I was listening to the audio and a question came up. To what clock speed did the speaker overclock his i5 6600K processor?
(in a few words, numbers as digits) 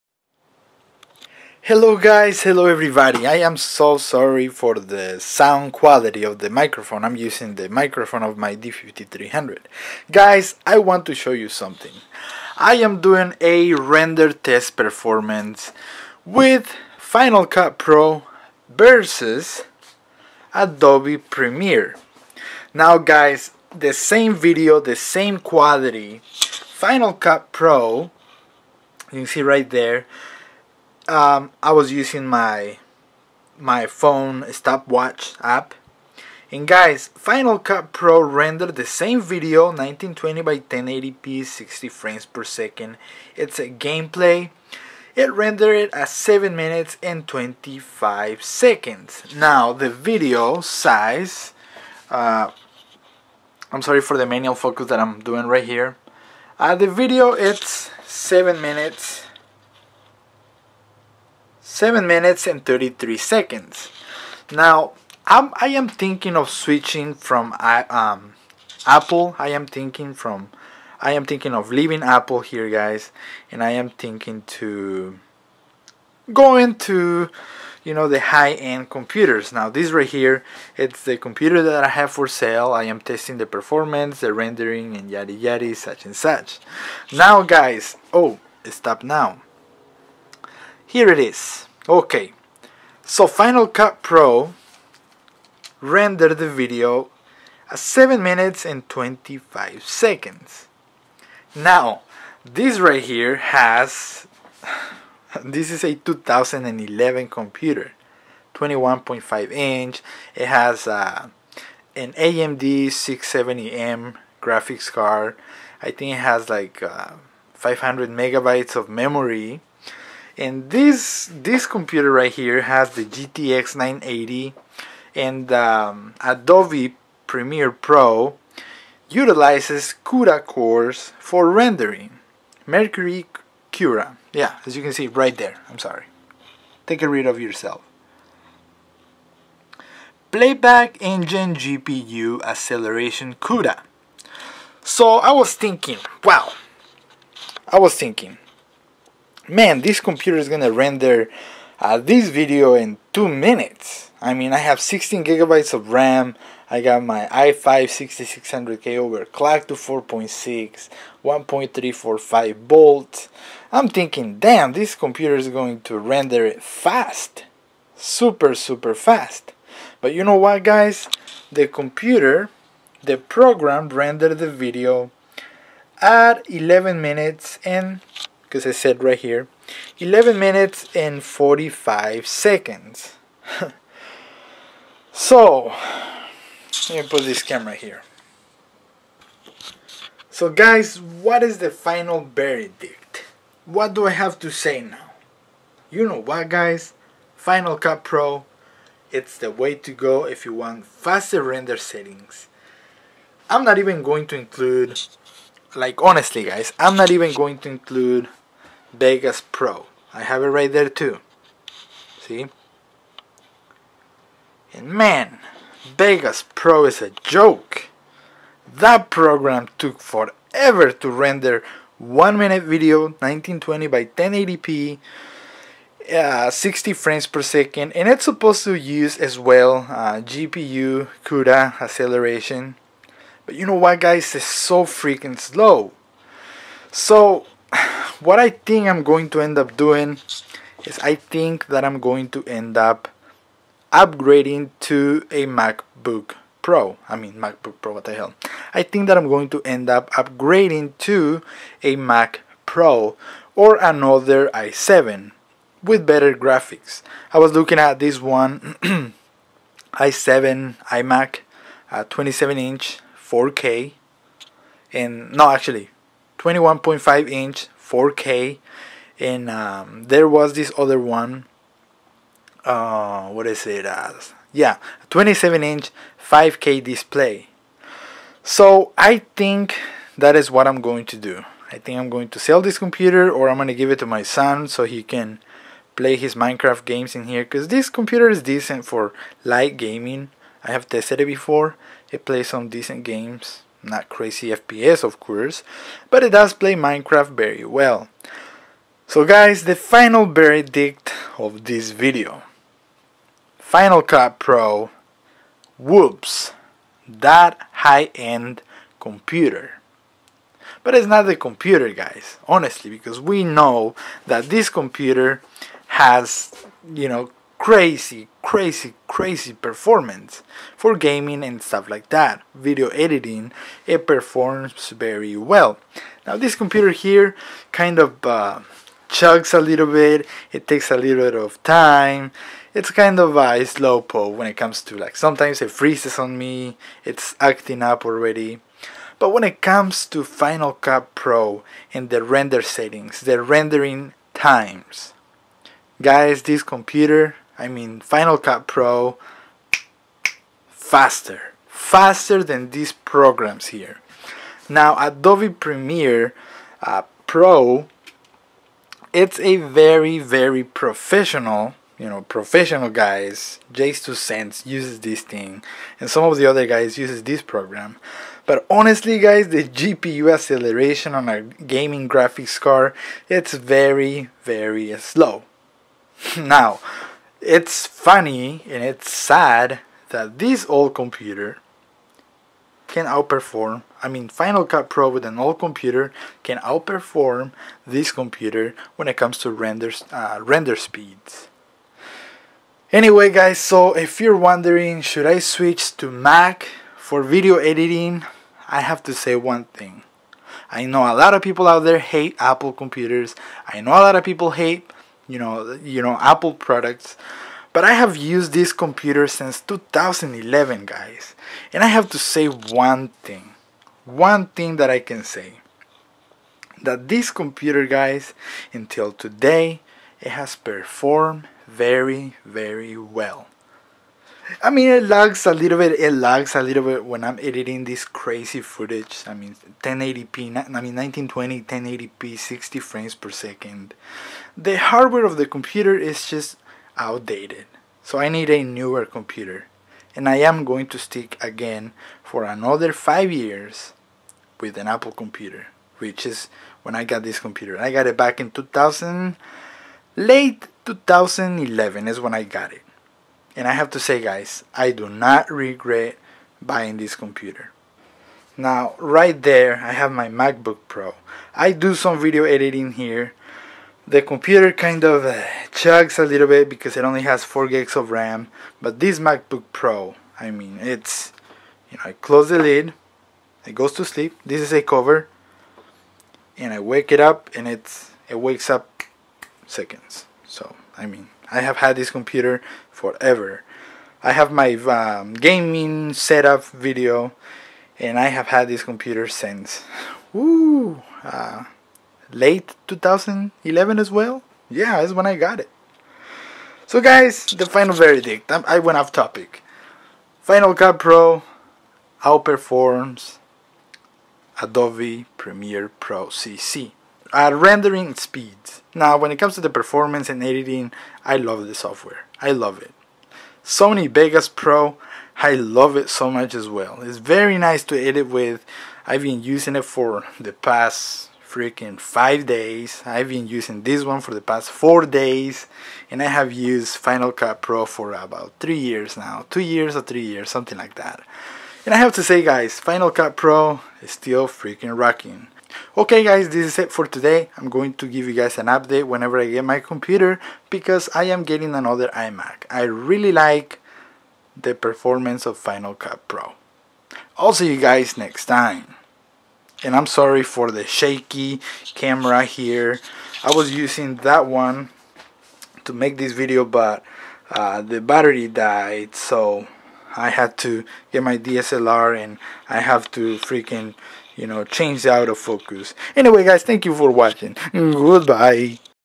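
4.6.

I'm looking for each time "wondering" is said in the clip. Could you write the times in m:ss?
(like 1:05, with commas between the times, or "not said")
6:34.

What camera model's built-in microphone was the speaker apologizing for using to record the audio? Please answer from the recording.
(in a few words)
D5300.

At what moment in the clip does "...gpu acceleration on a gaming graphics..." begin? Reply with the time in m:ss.
6:09.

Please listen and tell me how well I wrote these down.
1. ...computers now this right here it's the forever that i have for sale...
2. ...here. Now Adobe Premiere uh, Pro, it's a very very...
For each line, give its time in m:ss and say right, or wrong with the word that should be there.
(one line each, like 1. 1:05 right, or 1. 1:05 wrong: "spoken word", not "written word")
1. 1:18 wrong: "computer", not "forever"
2. 5:53 right.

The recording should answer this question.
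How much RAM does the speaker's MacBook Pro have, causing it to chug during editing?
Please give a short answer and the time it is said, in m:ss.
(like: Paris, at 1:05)
4 gigs, at 7:47.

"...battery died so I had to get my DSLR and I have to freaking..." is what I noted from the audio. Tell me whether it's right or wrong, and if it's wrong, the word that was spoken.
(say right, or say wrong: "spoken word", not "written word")
right.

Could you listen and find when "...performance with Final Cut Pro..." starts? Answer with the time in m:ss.
0:14.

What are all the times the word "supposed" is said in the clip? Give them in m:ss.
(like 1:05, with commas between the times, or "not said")
3:48.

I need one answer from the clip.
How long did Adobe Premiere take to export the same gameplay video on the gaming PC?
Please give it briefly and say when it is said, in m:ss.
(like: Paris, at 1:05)
11 minutes and 45 seconds, at 2:59.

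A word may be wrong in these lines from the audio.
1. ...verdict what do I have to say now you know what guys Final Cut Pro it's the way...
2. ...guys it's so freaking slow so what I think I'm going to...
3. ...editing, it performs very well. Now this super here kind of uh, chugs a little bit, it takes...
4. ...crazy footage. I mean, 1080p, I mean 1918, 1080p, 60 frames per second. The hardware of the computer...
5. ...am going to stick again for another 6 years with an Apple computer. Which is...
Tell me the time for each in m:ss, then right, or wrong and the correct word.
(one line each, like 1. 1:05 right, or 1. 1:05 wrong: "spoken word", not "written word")
1. 3:12 right
2. 3:53 right
3. 5:22 wrong: "computer", not "super"
4. 7:08 wrong: "1920", not "1918"
5. 7:20 wrong: "5", not "6".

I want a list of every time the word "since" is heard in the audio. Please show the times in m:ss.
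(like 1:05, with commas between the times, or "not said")
6:49, 8:09.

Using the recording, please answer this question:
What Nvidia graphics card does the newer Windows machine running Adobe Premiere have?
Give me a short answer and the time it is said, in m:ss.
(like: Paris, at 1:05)
GTX 980, at 2:03.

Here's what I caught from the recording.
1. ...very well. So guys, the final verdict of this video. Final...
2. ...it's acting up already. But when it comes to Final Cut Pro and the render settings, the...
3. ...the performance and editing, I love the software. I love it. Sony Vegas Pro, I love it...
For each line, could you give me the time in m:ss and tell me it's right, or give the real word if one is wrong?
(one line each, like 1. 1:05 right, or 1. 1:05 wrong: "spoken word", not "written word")
1. 4:57 right
2. 5:37 right
3. 8:29 right.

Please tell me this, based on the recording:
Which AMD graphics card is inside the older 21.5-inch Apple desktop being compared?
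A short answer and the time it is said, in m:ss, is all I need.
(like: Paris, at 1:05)
AMD 670M, at 1:52.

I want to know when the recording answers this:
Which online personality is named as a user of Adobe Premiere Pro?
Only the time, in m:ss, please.
6:03.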